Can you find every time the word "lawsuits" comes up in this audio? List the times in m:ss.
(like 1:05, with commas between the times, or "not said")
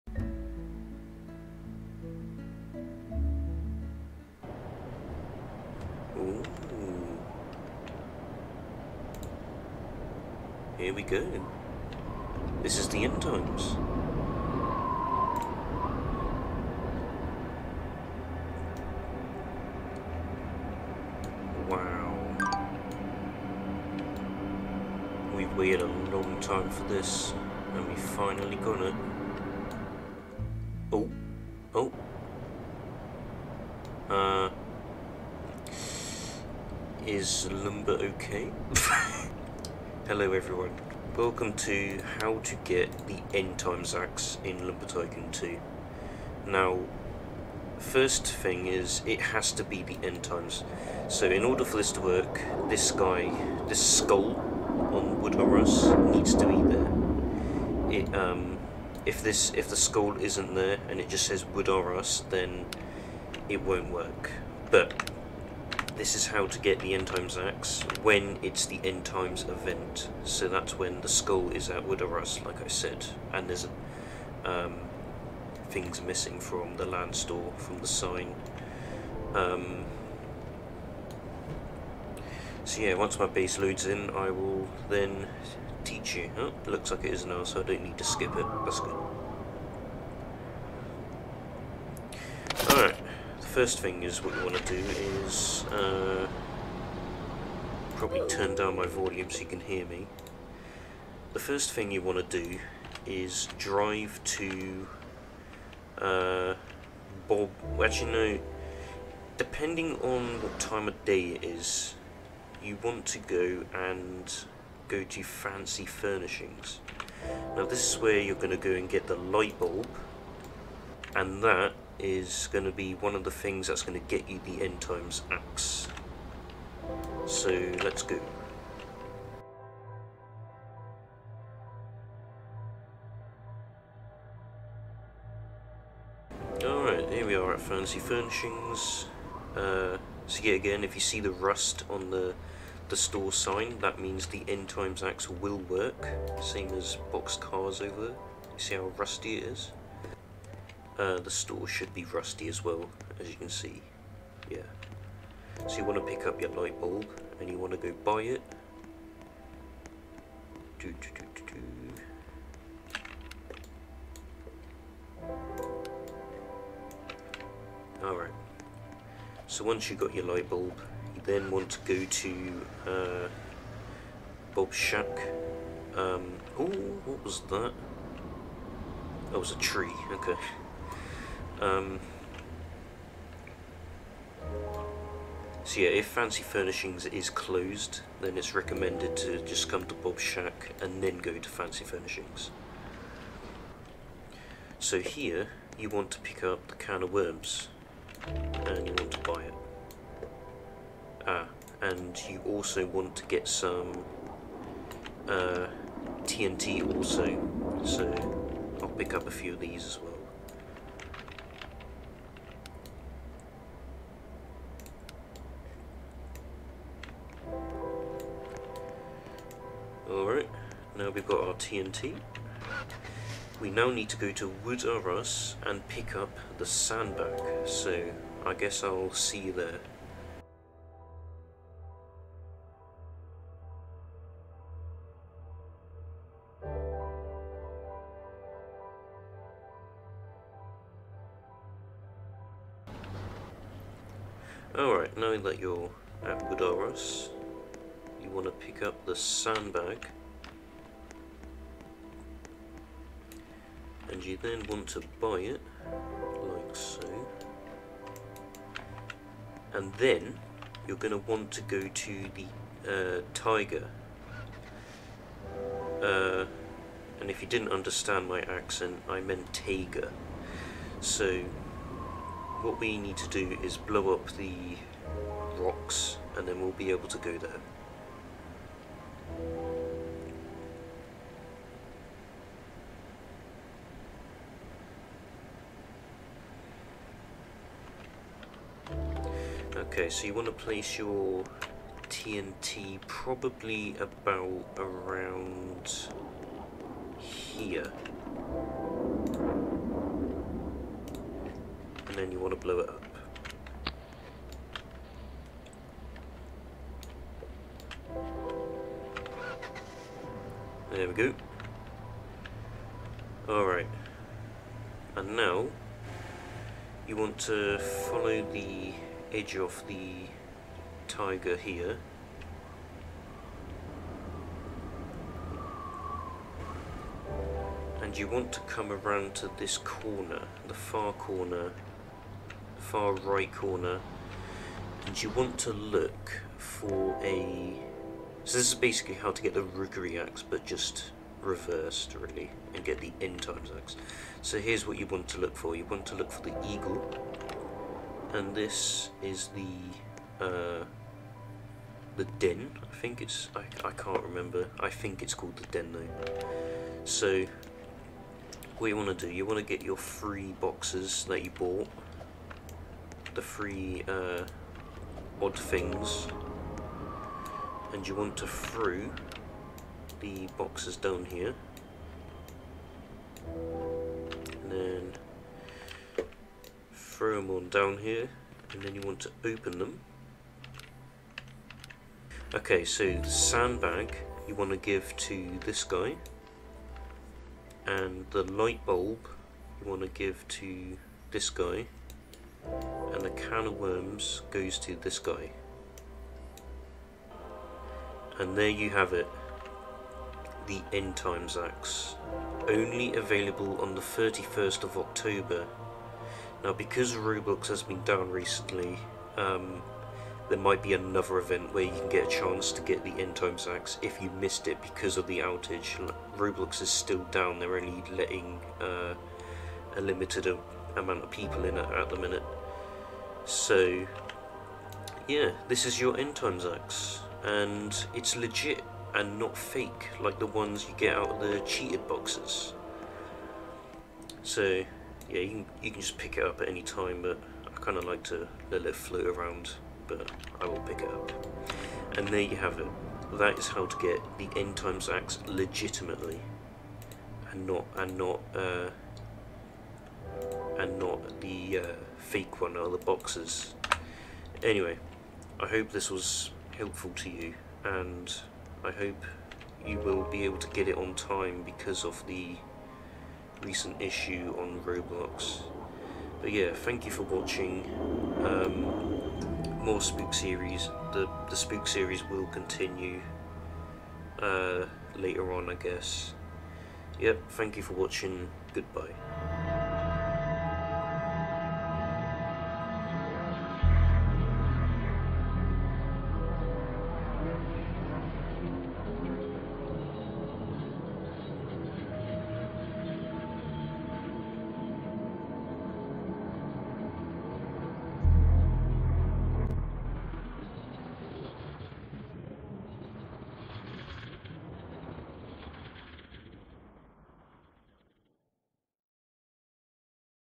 not said.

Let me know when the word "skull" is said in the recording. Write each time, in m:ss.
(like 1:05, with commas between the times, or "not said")
0:53, 0:59, 1:11.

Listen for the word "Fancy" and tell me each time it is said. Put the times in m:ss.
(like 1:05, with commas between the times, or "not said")
1:55, 2:17, 3:06, 3:11.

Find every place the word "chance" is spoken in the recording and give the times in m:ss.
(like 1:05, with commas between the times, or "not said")
6:52.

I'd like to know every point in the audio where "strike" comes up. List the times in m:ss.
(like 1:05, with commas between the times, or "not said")
not said.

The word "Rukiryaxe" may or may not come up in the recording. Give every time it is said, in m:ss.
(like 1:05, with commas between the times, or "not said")
5:39.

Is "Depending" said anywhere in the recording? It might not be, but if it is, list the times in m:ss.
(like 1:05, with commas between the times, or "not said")
1:49.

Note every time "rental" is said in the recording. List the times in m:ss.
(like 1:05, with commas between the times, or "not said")
not said.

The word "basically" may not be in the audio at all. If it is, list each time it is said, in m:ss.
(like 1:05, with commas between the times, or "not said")
5:38.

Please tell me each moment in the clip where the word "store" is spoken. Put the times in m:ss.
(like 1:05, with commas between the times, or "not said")
1:17, 2:22, 2:31.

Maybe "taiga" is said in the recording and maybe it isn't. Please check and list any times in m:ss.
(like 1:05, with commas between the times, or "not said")
4:23, 4:29, 5:21.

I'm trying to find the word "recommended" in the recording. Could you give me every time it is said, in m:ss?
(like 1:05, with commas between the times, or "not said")
3:08.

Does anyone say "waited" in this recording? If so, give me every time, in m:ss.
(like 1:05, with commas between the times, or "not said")
0:25.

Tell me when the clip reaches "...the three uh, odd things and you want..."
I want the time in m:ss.
6:03.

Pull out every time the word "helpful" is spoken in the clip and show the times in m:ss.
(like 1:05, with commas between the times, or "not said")
7:36.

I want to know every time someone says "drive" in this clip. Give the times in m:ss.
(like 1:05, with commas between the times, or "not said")
1:43.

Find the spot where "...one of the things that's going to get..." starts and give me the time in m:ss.
2:02.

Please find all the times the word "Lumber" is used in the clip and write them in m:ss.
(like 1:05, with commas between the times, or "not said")
0:37, 0:44.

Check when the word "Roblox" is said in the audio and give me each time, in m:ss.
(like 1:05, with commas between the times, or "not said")
6:47, 6:56, 7:44.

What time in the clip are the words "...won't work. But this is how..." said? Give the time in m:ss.
1:03.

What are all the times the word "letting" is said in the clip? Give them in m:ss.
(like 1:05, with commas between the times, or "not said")
6:58.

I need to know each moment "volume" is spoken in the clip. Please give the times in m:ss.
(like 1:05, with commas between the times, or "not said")
1:38.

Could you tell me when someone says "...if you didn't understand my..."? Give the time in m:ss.
4:27.